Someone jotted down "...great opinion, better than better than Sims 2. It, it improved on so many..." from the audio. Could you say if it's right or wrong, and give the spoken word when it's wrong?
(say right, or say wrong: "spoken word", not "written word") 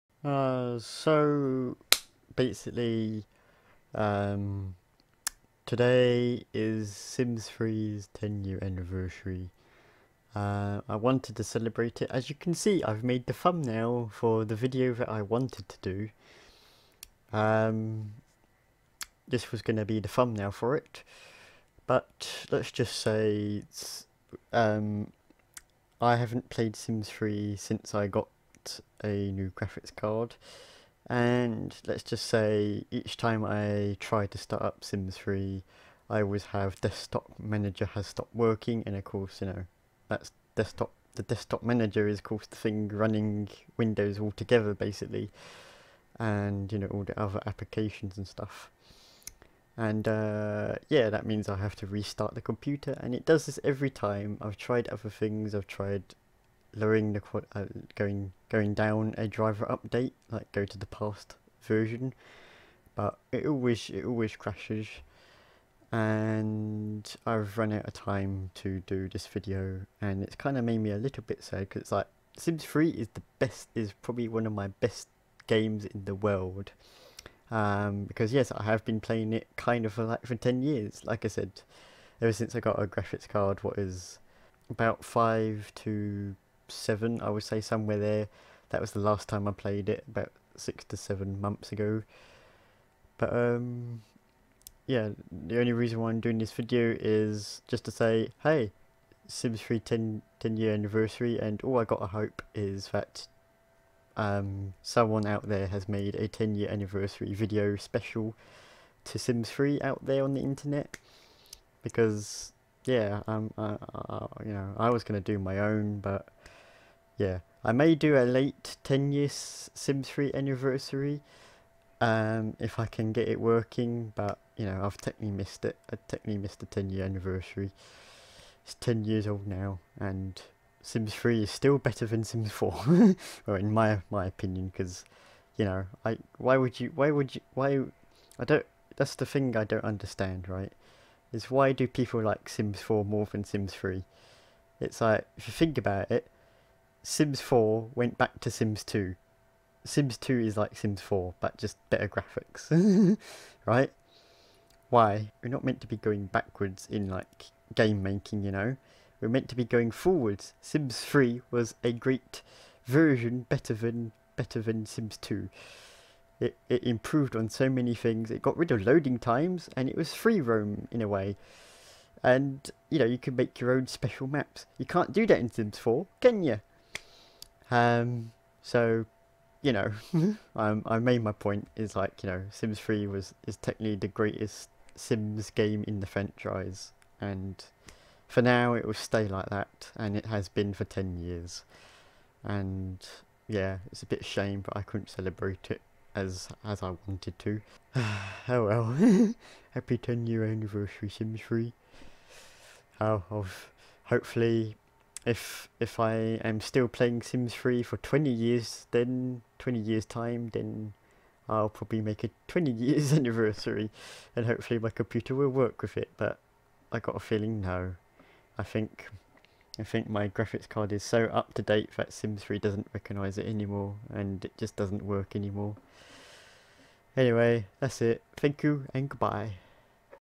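wrong: "version", not "opinion".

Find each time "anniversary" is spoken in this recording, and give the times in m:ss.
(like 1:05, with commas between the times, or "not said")
0:08, 1:40, 1:46, 2:00, 2:07, 3:20, 3:33.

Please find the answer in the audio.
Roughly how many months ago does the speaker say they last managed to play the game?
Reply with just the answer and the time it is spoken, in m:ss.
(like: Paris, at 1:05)
6 to 7 months, at 1:30.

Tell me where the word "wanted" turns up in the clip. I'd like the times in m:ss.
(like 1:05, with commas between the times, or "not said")
0:10, 0:15, 3:17.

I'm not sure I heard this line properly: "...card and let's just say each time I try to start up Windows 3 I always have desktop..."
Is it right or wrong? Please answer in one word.
wrong.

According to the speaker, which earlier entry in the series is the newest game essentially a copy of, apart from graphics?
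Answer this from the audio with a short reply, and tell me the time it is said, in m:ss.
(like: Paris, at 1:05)
Sims 2, at 2:29.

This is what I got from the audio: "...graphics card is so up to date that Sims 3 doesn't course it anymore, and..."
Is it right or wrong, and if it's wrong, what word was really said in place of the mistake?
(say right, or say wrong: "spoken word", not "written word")
wrong: "recognise", not "course".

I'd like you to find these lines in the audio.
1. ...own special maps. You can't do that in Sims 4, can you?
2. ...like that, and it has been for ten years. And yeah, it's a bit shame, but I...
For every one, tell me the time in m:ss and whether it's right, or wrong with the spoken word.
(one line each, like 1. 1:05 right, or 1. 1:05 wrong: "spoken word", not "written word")
1. 2:53 right
2. 3:09 right.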